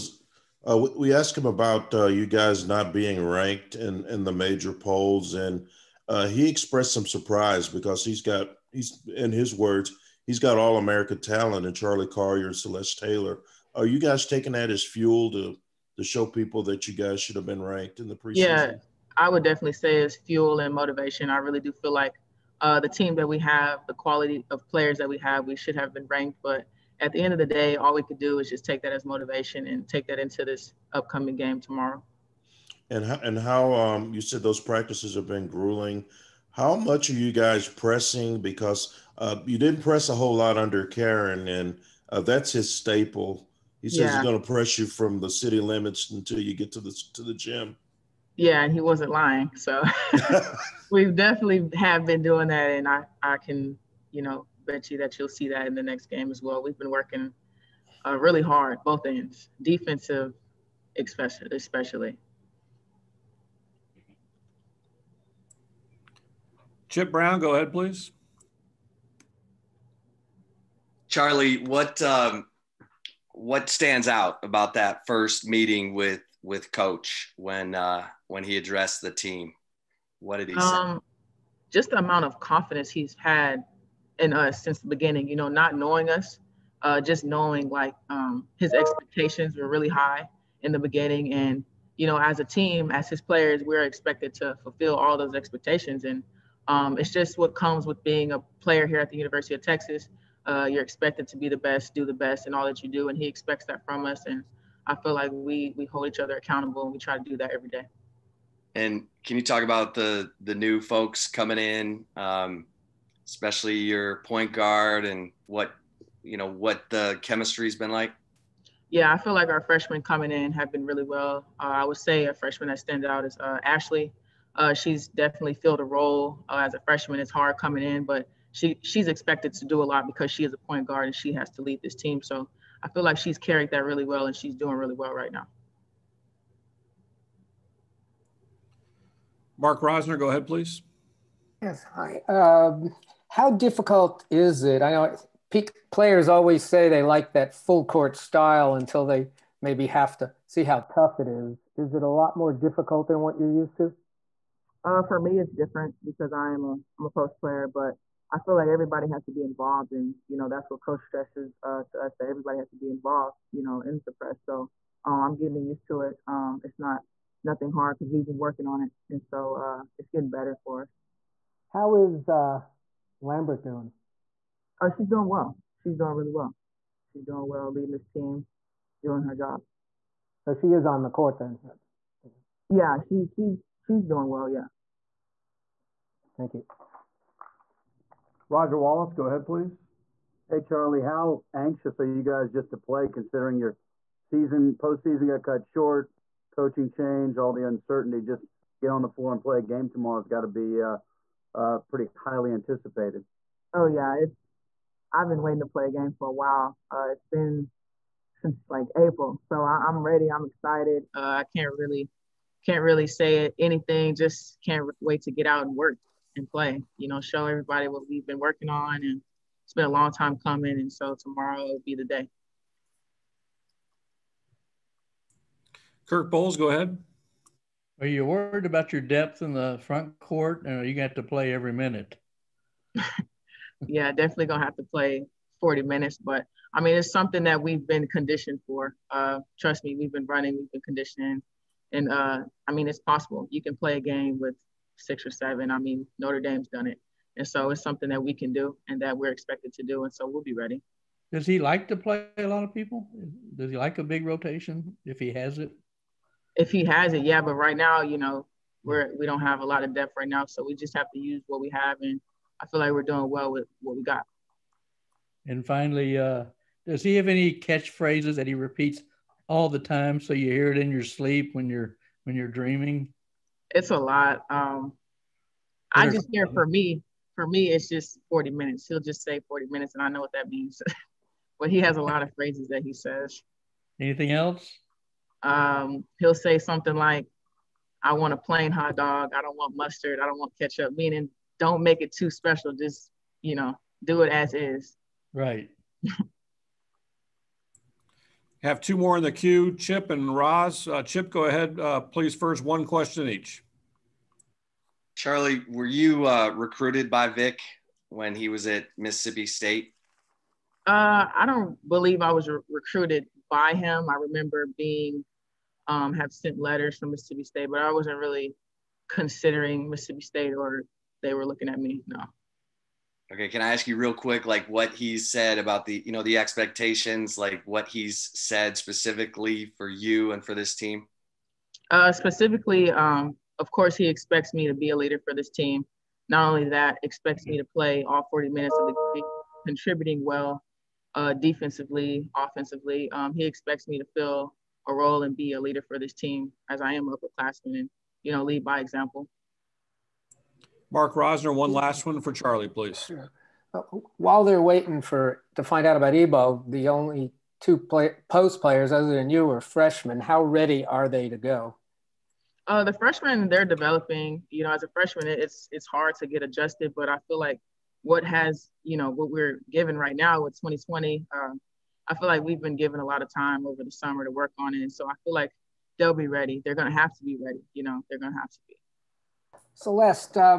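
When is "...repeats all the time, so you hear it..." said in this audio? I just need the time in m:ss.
4:28.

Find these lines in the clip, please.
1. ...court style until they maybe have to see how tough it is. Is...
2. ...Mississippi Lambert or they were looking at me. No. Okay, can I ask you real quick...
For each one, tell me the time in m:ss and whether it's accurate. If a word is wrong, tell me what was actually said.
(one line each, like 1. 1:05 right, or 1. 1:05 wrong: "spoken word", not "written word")
1. 2:27 right
2. 5:19 wrong: "State", not "Lambert".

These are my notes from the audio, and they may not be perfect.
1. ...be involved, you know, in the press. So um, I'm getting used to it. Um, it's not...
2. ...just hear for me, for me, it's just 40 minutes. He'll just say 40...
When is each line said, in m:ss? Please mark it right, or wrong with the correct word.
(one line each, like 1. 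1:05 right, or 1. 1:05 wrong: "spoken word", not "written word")
1. 2:42 right
2. 4:36 right.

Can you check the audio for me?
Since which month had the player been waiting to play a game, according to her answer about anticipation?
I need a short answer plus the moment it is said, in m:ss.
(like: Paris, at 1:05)
April, at 3:28.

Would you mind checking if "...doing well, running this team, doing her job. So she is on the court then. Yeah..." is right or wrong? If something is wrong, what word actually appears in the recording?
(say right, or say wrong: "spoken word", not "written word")
wrong: "leading", not "running".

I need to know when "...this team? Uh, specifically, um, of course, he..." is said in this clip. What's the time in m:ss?
5:30.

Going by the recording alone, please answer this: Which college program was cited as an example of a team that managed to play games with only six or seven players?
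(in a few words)
Notre Dame.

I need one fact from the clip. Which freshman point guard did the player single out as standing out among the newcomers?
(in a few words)
Ashley.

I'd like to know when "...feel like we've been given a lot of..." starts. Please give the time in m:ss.
6:12.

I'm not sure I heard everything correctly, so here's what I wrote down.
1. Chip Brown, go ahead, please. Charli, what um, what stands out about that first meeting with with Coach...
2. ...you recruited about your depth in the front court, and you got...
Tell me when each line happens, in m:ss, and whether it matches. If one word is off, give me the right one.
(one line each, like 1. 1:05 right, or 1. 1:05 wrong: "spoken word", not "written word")
1. 1:06 right
2. 3:48 wrong: "worried", not "recruited".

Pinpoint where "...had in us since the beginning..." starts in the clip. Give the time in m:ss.
1:23.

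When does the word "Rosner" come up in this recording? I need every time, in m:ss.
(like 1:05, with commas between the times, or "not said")
2:19, 5:51.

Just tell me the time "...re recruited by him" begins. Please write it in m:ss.
5:12.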